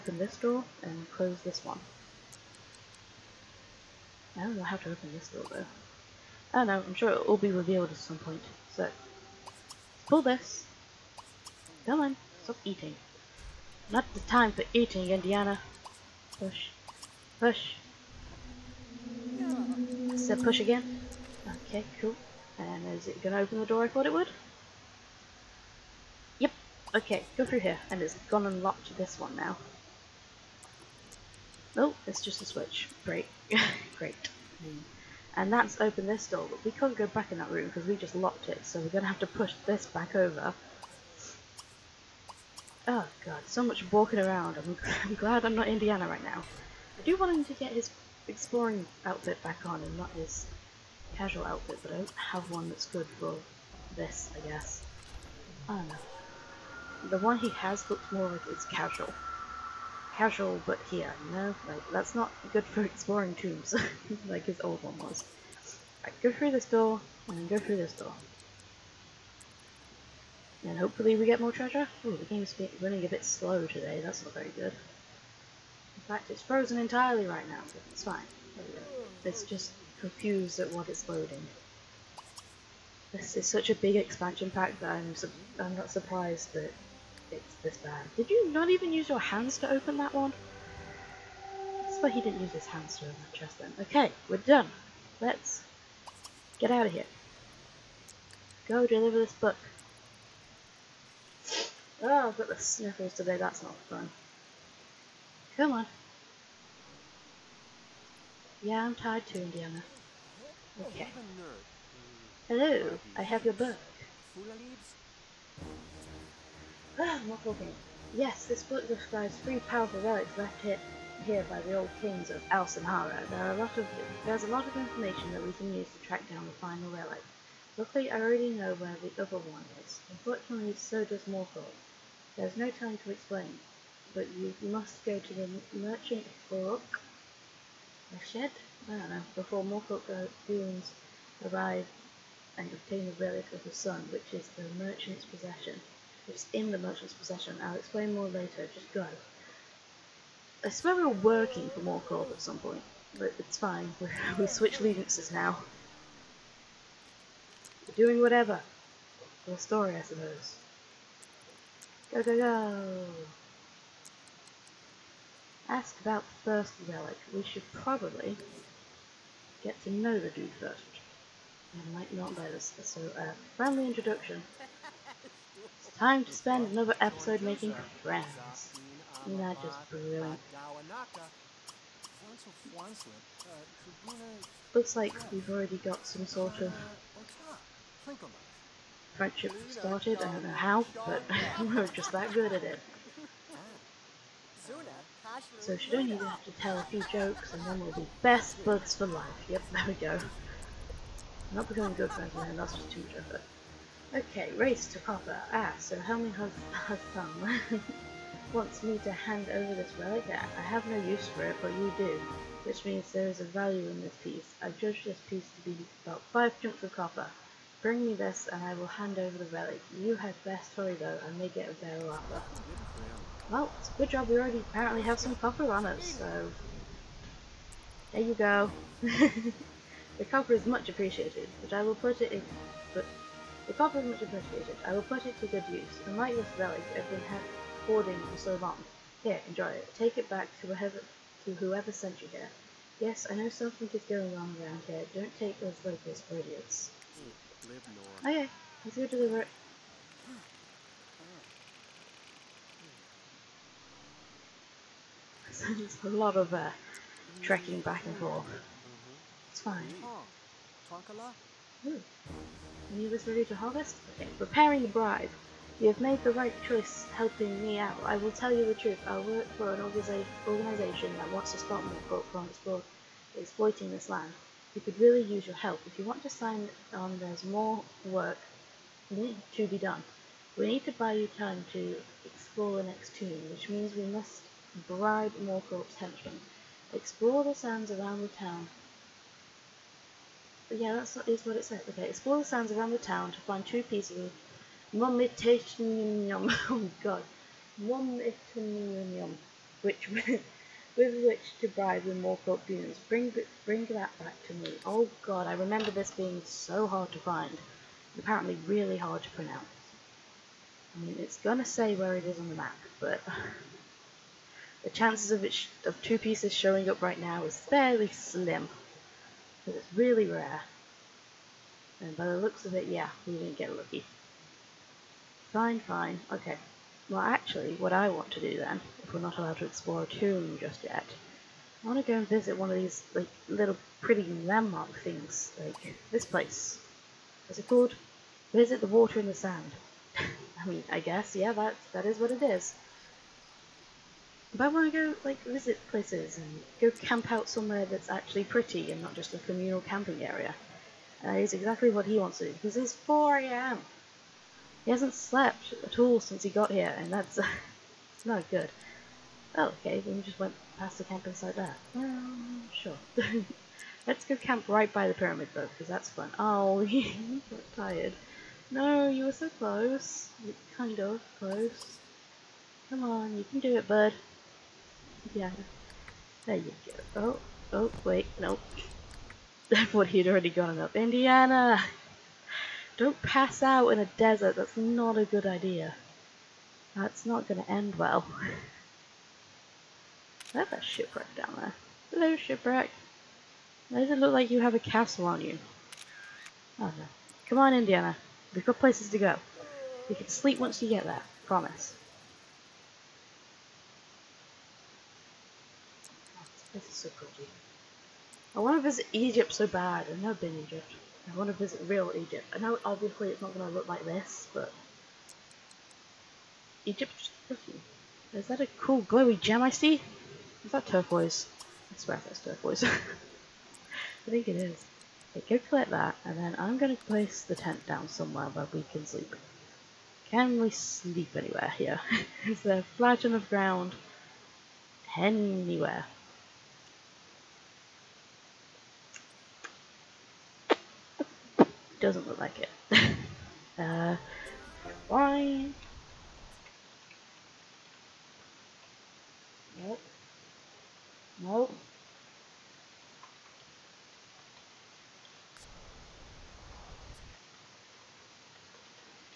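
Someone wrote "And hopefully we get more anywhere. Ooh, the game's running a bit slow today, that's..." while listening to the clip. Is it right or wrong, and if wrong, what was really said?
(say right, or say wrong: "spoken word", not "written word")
wrong: "treasure", not "anywhere".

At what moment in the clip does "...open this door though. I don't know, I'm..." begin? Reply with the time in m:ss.
0:04.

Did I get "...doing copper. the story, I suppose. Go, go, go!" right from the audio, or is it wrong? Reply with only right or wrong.
wrong.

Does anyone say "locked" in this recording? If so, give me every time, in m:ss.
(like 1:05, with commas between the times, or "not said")
0:28, 0:38.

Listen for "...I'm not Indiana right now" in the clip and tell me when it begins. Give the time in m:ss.
0:45.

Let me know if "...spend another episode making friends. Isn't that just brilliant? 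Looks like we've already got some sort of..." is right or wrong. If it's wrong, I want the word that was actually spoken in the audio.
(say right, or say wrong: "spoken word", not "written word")
right.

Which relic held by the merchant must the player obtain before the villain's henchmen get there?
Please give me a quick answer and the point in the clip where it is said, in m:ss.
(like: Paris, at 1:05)
the relic of the sun, at 2:23.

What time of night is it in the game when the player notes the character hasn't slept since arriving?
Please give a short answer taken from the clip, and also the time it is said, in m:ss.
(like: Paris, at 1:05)
4 a.m., at 5:52.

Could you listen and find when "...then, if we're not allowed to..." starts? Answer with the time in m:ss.
5:28.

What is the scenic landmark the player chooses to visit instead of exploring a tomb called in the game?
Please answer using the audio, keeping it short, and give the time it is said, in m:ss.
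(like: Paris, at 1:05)
Visit the Water in the Sand, at 5:38.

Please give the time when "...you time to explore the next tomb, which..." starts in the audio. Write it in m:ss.
4:41.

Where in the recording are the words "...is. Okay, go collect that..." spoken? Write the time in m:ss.
7:04.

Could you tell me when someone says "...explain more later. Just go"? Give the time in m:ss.
2:27.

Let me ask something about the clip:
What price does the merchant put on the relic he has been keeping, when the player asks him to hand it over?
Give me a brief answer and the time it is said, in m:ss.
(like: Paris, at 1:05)
5 chunks of copper, at 3:36.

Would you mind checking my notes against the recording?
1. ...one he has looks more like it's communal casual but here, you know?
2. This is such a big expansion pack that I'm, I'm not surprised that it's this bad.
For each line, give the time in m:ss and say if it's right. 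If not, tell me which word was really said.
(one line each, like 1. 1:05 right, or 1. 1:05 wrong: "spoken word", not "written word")
1. 0:57 wrong: "casual", not "communal"
2. 1:23 right.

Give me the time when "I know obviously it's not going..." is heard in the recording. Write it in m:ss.
6:52.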